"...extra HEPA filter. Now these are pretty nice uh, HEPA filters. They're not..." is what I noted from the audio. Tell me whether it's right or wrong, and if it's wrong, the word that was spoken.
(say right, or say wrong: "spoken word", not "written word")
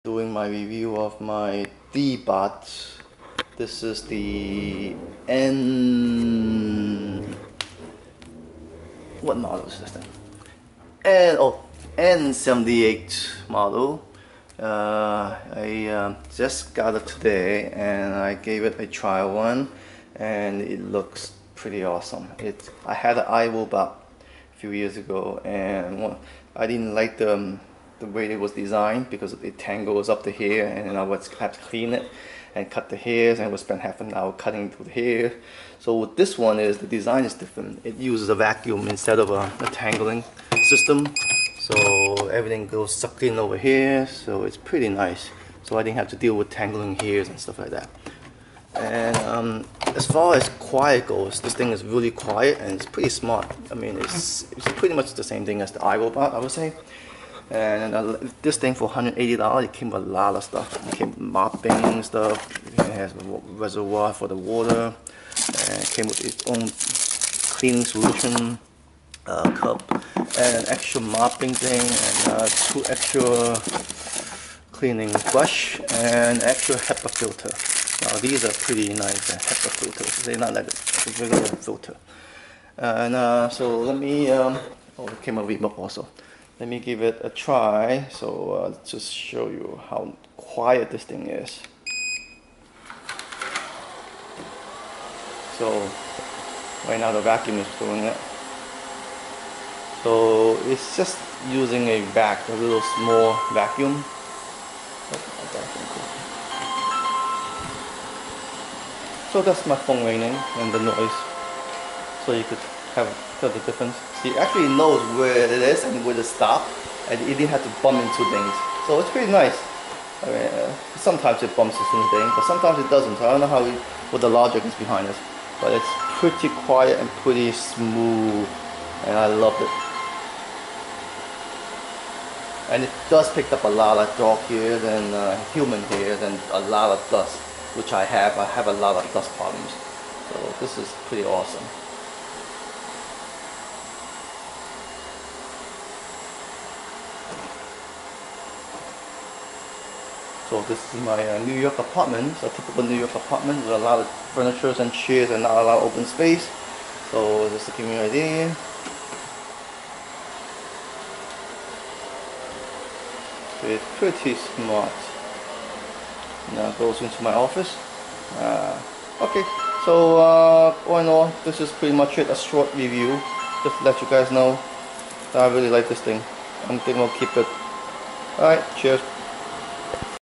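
right.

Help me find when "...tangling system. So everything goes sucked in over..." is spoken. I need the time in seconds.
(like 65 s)
39 s.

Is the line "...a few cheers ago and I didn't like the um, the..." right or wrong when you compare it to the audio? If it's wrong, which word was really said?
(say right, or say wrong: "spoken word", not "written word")
wrong: "years", not "cheers".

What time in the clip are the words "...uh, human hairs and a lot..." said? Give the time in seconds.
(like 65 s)
135 s.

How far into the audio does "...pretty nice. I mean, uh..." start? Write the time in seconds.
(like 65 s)
119 s.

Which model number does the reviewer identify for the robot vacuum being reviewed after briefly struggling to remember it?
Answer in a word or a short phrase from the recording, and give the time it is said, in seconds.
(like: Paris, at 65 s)
N78, at 11 s.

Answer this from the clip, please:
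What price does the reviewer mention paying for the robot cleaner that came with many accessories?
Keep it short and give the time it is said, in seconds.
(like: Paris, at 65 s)
$180, at 58 s.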